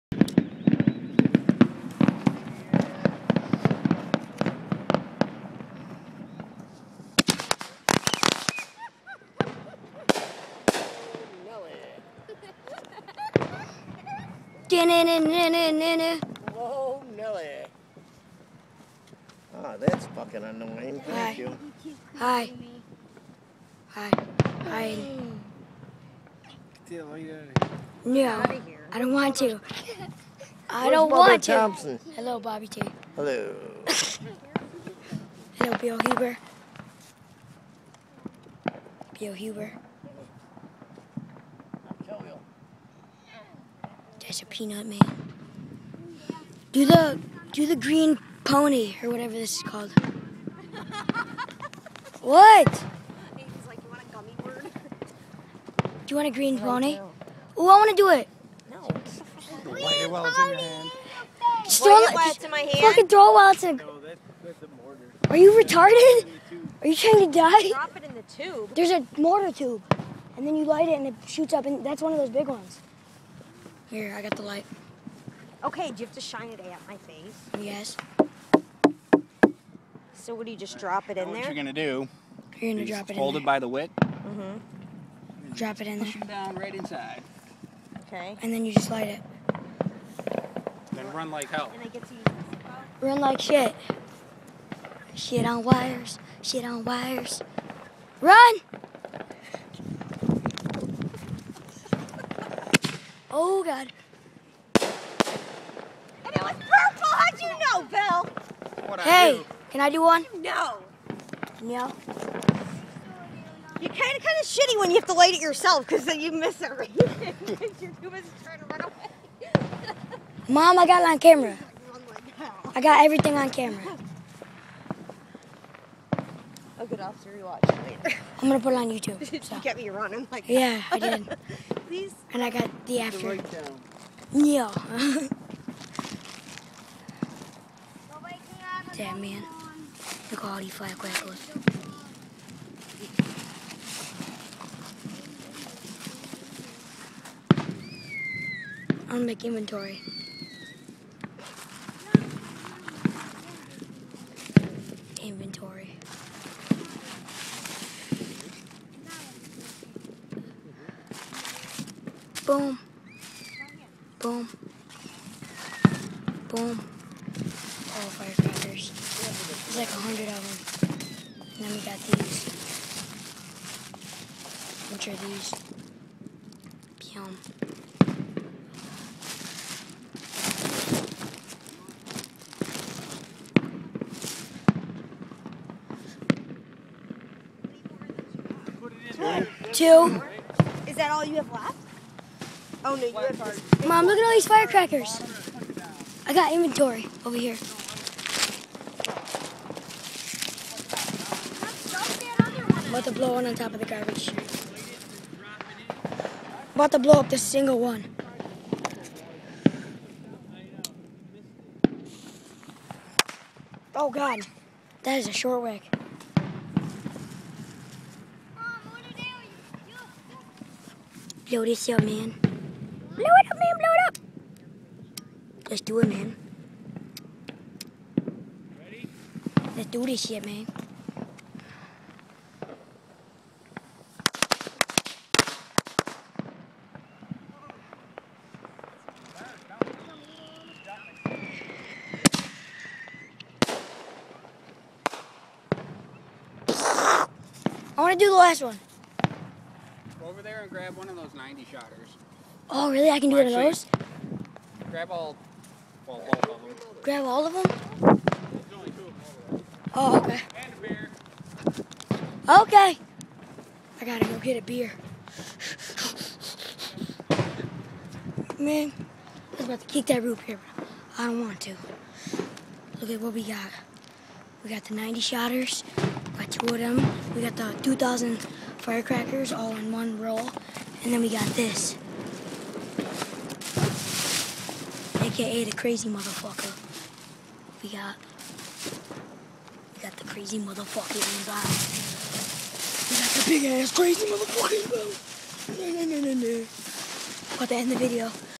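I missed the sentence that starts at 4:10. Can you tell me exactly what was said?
Go over there and grab one of those 90 shotters.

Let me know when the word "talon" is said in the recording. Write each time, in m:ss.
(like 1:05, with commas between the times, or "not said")
not said.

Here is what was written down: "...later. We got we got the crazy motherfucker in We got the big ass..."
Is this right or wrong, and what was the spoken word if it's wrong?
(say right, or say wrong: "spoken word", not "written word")
wrong: "motherfucker", not "later".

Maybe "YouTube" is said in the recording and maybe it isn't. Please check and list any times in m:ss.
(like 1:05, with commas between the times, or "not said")
2:08.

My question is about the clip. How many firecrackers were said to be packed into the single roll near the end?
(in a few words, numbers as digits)
2000.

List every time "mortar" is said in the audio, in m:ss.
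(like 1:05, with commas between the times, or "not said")
1:03, 1:09.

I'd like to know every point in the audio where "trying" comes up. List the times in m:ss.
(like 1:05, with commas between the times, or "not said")
1:06, 1:58.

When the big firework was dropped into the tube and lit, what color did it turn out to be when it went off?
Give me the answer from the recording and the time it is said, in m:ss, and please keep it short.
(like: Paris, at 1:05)
purple, at 1:46.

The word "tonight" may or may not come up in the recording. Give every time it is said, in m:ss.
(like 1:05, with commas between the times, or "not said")
not said.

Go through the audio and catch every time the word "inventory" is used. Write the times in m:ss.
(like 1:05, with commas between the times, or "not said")
2:29, 3:16.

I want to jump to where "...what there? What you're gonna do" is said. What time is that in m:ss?
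1:21.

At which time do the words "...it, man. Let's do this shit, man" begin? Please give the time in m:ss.
3:45.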